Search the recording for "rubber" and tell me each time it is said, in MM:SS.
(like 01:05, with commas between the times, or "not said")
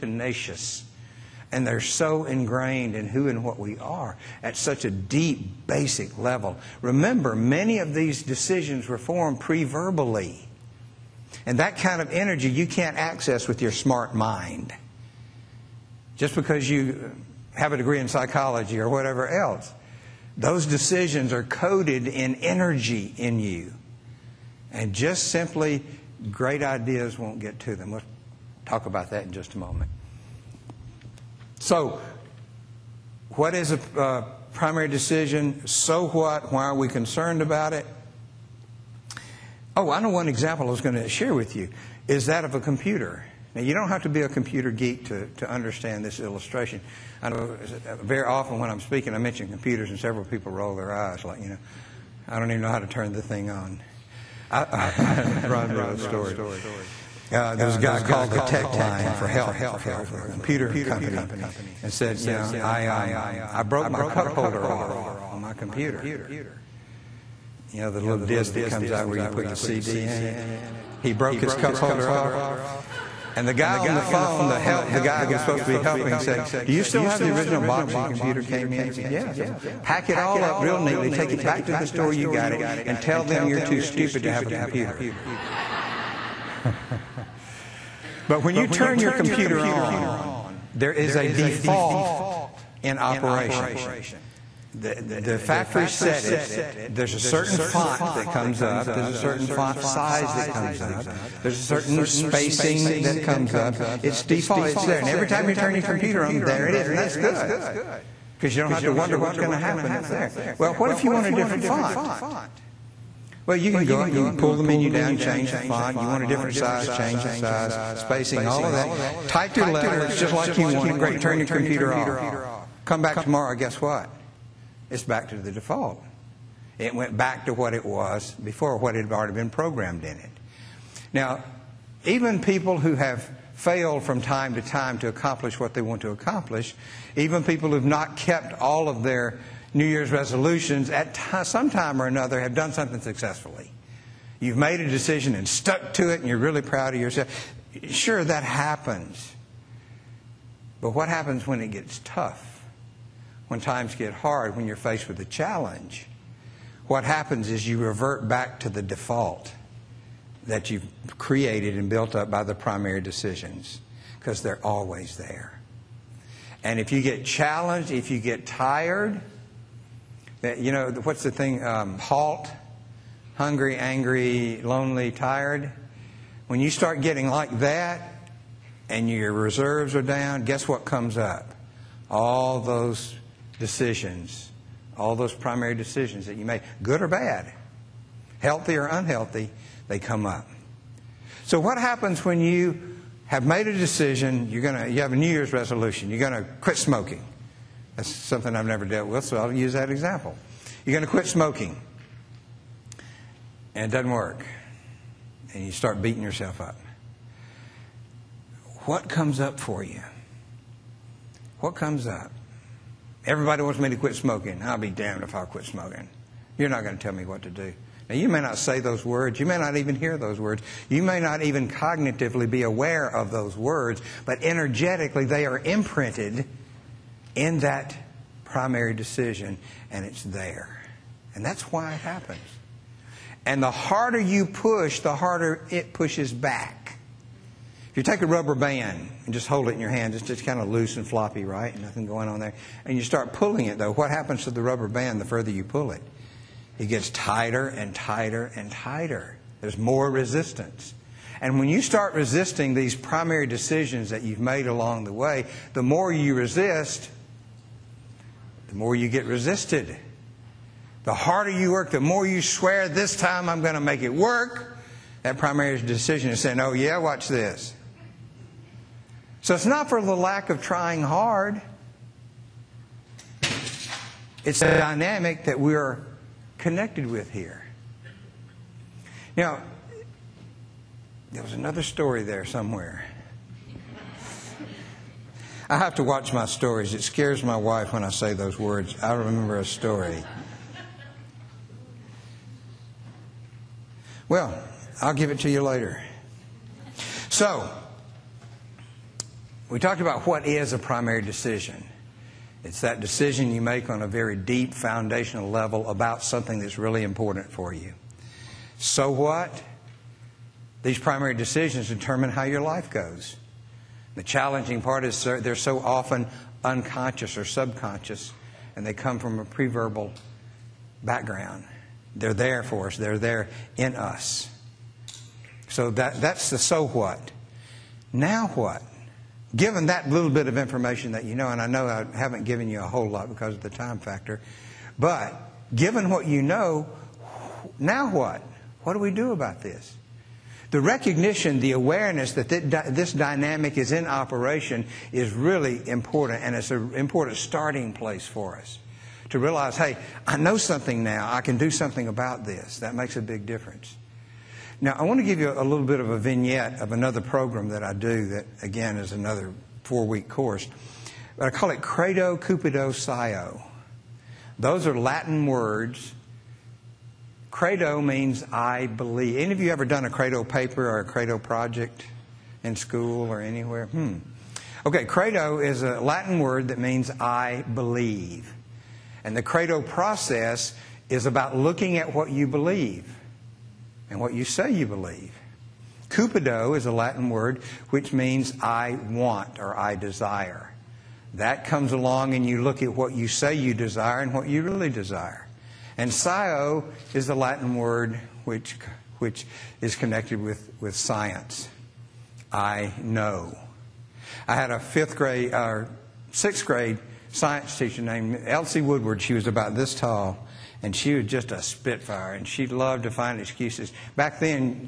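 03:58, 04:04.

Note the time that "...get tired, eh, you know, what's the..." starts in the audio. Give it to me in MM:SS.
02:48.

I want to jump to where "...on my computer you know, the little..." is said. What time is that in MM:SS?
01:05.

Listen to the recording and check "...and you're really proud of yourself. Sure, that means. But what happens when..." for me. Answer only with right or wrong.
wrong.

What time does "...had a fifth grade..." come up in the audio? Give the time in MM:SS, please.
06:44.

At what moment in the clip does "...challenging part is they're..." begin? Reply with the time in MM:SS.
05:14.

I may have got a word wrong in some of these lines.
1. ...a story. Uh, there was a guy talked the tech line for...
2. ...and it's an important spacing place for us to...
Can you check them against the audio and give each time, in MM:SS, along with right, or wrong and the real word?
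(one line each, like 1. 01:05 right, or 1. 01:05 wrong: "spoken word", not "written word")
1. 00:55 wrong: "called", not "talked"
2. 05:46 wrong: "starting", not "spacing".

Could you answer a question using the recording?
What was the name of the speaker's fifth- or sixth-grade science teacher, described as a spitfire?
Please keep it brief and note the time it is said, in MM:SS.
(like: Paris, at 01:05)
Elsie Woodward, at 06:48.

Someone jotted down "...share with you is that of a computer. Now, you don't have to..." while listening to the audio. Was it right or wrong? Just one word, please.
right.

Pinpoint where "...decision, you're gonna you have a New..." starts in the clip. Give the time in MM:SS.
03:13.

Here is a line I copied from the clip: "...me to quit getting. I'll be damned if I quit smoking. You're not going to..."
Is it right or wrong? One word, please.
wrong.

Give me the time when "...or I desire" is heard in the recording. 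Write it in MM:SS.
06:29.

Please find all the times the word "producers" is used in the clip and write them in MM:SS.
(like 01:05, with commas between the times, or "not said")
not said.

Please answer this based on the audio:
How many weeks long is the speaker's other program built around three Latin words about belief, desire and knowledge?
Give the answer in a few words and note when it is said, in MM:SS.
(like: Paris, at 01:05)
4, at 05:59.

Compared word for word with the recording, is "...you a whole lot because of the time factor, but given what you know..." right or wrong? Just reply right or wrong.
right.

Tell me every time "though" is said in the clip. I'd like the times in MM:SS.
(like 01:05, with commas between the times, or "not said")
04:03.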